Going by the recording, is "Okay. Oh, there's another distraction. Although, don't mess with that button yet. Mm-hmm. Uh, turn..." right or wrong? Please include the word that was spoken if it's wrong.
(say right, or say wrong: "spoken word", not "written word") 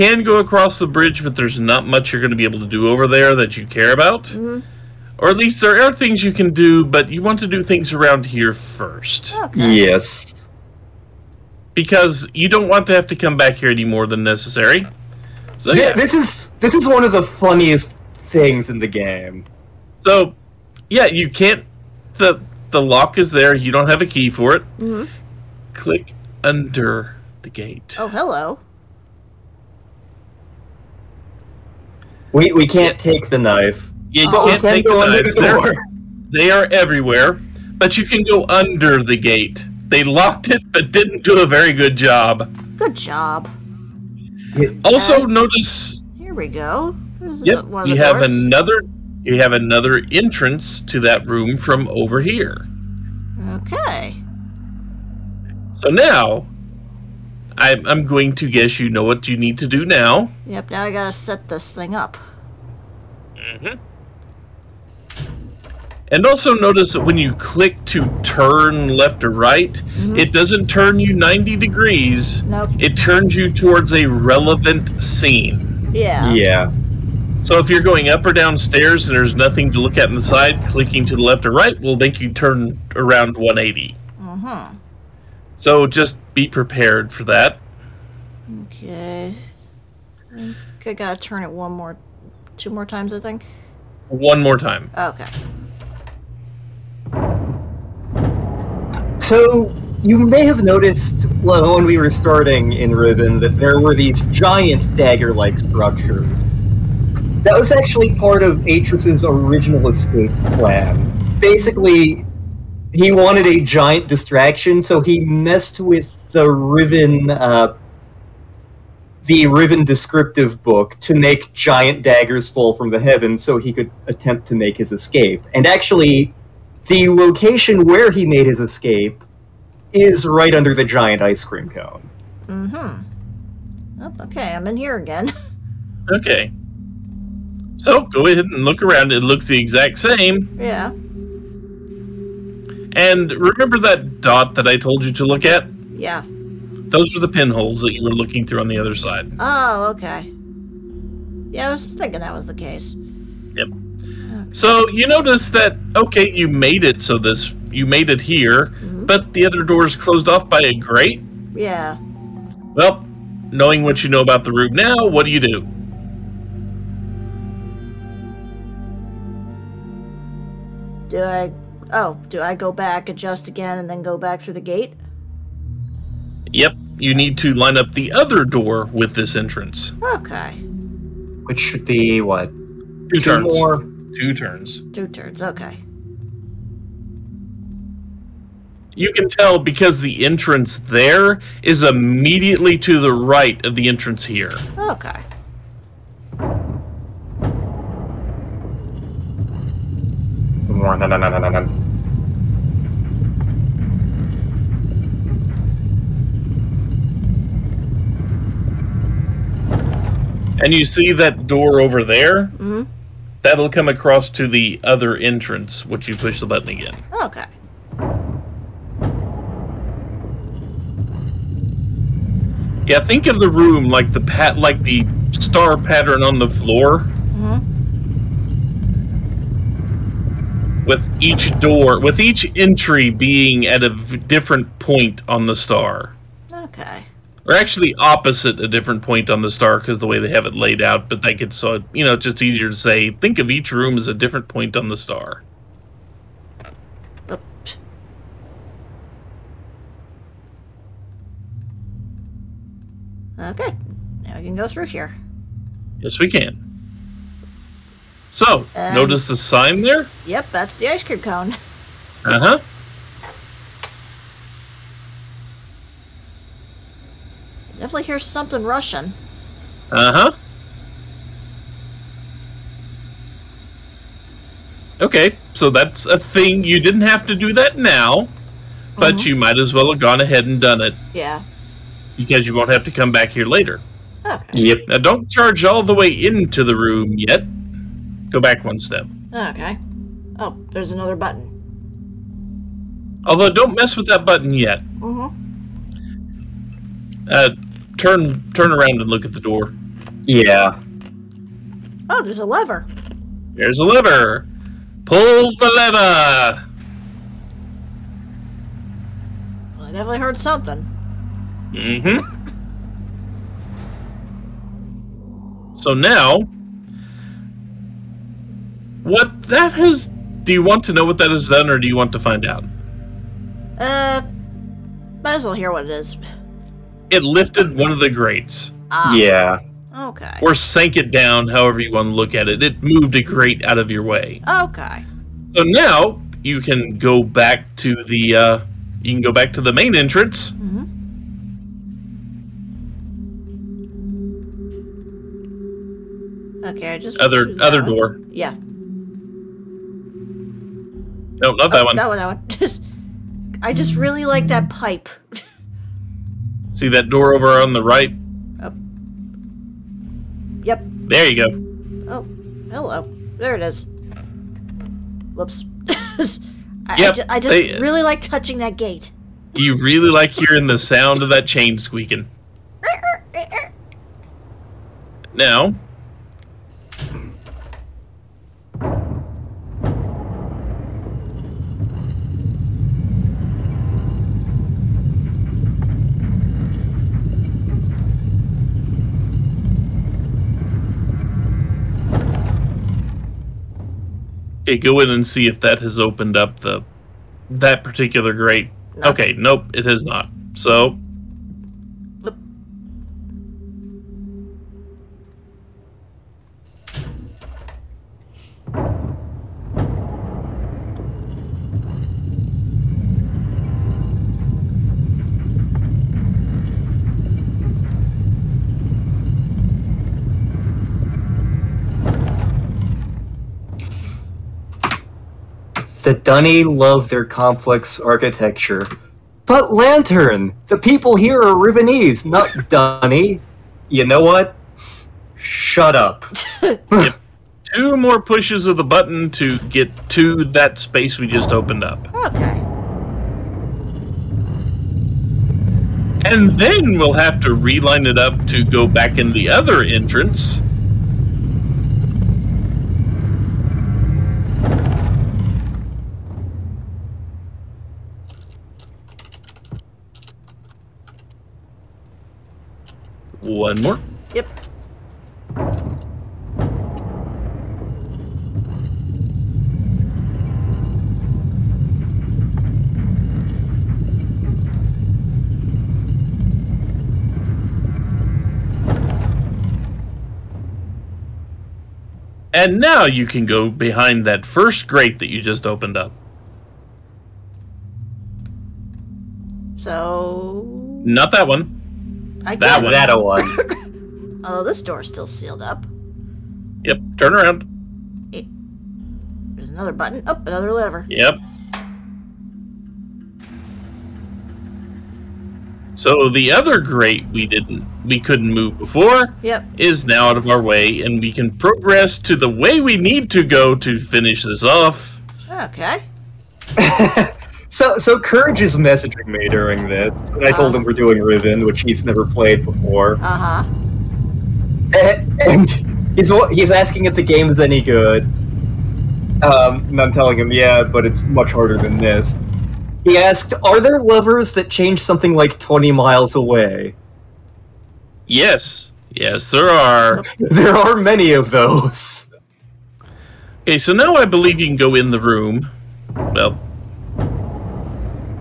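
wrong: "button", not "distraction".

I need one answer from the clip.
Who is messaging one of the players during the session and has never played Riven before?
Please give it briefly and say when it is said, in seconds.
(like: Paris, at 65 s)
Courage, at 518 s.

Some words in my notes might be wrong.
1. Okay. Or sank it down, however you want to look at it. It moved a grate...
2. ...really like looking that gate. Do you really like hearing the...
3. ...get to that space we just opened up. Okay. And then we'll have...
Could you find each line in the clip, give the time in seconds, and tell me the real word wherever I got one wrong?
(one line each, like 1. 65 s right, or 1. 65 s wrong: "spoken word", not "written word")
1. 329 s right
2. 367 s wrong: "touching", not "looking"
3. 439 s right.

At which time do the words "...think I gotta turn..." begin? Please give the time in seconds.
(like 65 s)
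90 s.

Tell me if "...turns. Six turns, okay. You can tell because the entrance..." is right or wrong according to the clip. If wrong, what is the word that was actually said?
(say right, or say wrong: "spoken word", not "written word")
wrong: "Two", not "Six".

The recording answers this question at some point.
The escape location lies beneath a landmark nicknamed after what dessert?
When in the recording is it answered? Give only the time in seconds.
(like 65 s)
130 s.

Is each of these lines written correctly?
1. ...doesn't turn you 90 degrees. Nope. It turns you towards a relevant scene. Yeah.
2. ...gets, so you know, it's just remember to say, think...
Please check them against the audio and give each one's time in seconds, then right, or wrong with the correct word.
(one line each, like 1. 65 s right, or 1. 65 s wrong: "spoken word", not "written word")
1. 70 s right
2. 241 s wrong: "easier", not "remember".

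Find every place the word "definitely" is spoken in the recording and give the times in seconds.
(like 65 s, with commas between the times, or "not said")
267 s, 309 s.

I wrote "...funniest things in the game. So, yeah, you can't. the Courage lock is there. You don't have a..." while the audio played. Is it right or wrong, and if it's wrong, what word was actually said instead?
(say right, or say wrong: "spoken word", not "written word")
wrong: "The", not "Courage".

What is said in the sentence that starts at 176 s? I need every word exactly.
Yep, you need to line up the other door with this entrance.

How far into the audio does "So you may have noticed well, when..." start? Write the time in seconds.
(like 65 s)
99 s.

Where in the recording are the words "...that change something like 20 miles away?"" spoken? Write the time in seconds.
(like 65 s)
534 s.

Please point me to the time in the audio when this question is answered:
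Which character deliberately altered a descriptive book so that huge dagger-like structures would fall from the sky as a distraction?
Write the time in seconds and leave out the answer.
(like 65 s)
108 s.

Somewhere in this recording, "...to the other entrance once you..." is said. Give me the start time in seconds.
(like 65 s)
214 s.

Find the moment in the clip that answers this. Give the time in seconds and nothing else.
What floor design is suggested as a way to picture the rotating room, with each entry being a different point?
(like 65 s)
225 s.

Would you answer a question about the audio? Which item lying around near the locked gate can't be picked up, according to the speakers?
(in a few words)
Knives.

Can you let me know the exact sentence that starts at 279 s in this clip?
you might as well have gone ahead and done it.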